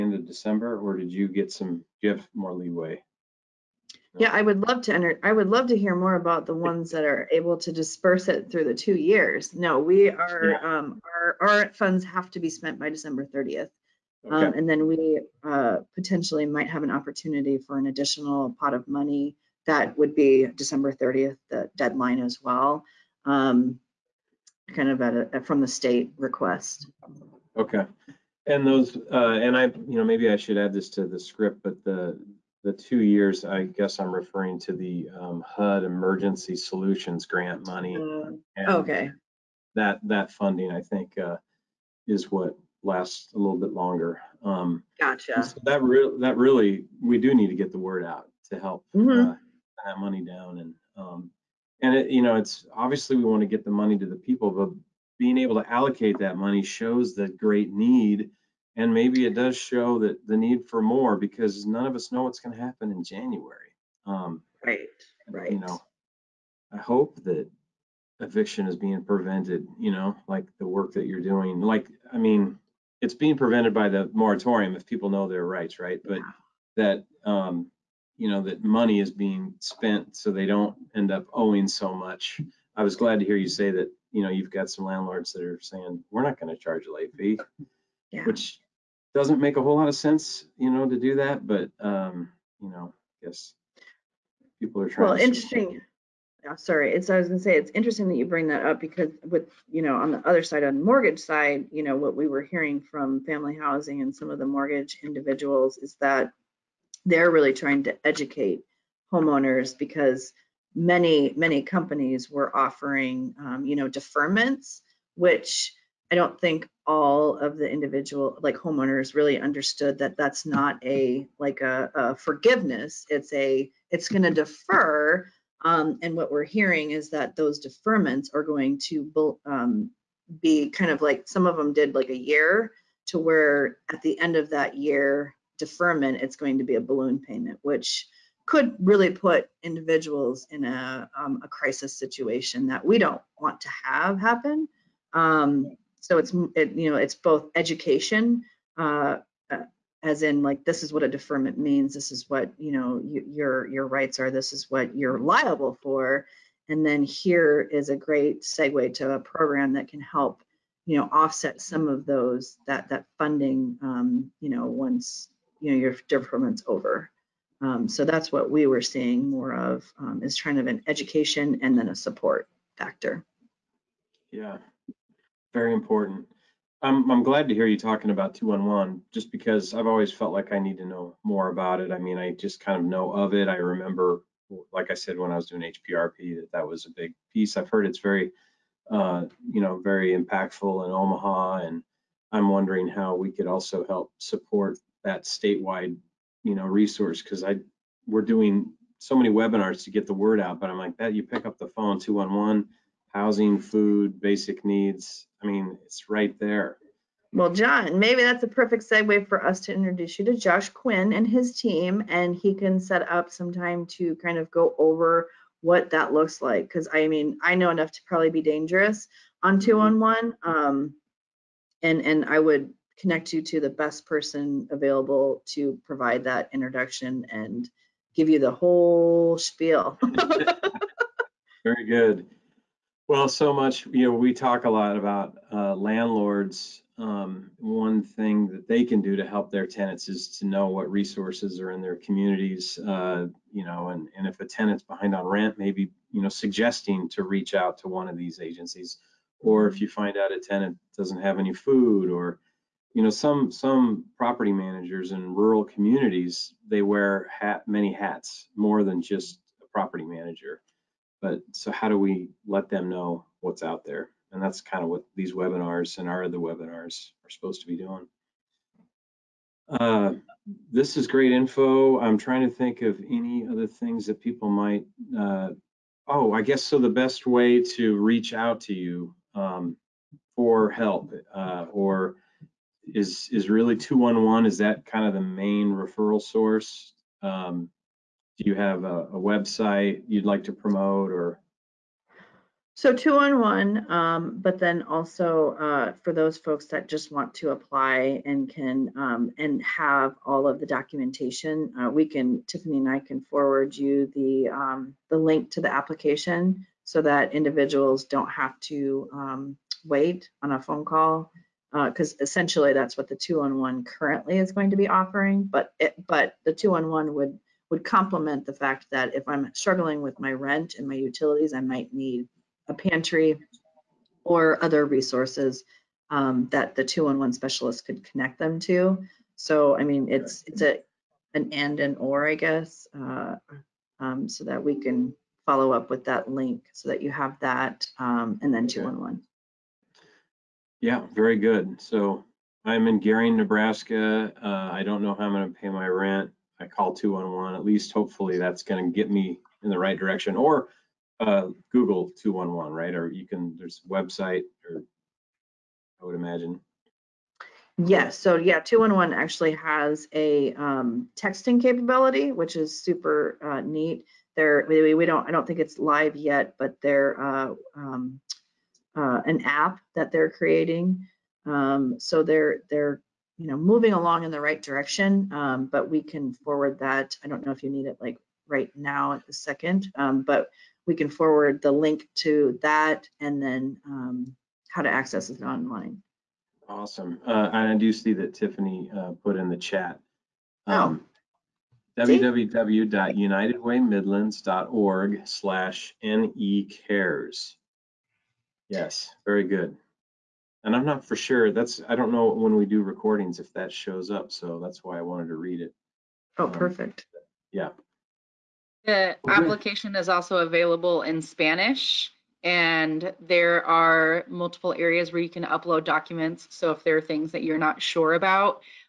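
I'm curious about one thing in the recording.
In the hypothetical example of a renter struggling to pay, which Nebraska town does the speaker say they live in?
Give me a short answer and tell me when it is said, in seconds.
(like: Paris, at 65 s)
Gering, at 343 s.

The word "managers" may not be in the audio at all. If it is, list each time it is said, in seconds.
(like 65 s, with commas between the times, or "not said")
254 s, 260 s.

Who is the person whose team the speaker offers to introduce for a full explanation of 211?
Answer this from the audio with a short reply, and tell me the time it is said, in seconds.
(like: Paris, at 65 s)
Josh Quinn, at 210 s.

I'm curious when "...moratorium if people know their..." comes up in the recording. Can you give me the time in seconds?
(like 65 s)
74 s.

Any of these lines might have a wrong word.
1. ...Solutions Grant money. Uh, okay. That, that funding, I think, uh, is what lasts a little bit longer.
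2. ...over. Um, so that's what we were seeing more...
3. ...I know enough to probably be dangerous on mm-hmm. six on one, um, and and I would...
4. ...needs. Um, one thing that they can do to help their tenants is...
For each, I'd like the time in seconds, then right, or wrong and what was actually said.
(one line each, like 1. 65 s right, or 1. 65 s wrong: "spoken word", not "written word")
1. 36 s right
2. 166 s right
3. 217 s wrong: "two", not "six"
4. 235 s wrong: "landlords", not "needs".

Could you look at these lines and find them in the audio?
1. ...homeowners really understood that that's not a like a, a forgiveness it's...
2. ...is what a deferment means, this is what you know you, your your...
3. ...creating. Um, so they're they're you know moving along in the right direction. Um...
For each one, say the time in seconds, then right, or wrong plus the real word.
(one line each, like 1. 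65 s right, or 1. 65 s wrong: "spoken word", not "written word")
1. 118 s right
2. 150 s right
3. 370 s right.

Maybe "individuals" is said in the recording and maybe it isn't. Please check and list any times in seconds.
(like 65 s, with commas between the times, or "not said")
105 s, 117 s, 139 s, 307 s.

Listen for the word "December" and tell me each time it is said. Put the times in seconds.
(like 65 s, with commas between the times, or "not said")
0 s, 12 s, 20 s.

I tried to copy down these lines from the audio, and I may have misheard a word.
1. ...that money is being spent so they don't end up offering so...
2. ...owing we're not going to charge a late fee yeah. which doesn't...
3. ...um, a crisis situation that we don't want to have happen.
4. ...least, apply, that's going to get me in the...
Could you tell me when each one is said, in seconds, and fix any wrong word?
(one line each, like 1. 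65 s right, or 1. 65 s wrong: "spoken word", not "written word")
1. 78 s wrong: "owing", not "offering"
2. 85 s wrong: "saying", not "owing"
3. 141 s right
4. 347 s wrong: "hopefully", not "apply".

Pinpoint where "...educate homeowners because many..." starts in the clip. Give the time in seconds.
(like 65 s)
108 s.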